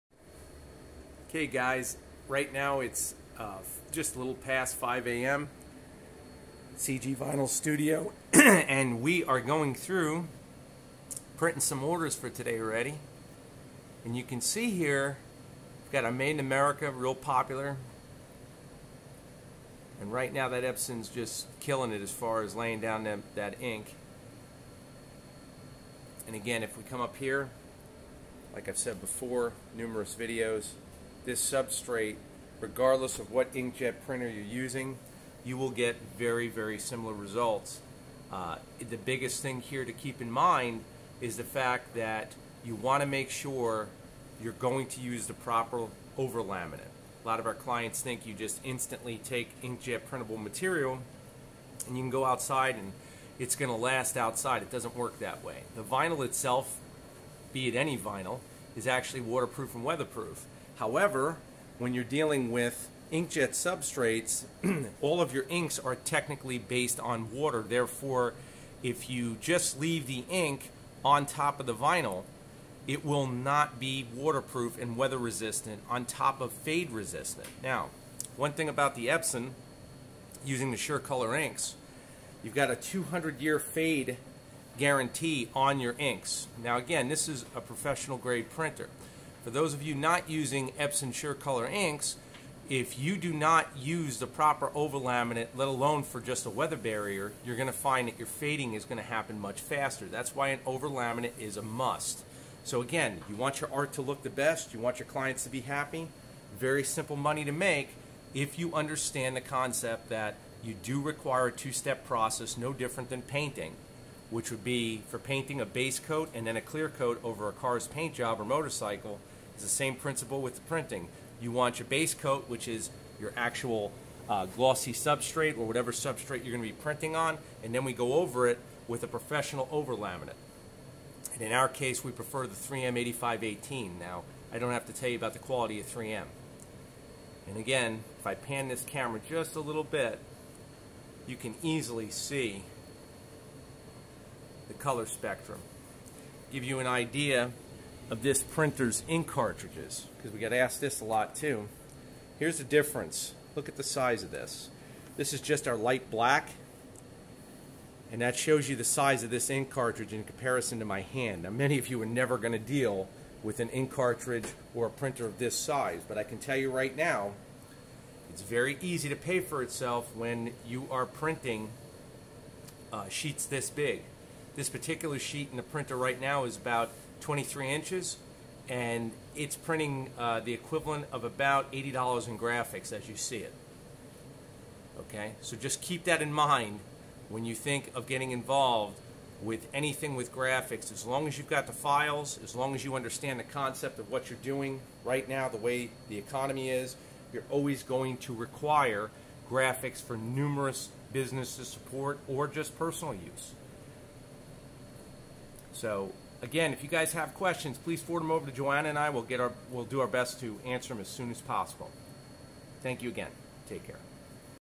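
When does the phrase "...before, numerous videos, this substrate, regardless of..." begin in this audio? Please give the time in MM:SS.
00:28.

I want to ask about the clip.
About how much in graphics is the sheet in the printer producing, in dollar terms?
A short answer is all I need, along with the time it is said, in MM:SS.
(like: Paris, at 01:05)
$80, at 03:01.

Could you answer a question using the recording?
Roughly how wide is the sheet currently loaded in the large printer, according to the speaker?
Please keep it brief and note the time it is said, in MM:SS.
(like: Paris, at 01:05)
23 inches, at 02:57.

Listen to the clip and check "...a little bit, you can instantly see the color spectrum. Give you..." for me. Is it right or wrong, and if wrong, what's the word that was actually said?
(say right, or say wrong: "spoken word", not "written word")
wrong: "easily", not "instantly".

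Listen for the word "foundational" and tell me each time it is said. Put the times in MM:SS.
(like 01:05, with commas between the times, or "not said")
not said.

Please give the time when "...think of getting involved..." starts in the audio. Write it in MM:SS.
03:07.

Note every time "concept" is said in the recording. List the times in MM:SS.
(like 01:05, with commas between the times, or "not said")
01:49, 03:13.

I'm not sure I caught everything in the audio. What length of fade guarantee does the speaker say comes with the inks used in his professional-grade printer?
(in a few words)
200 years.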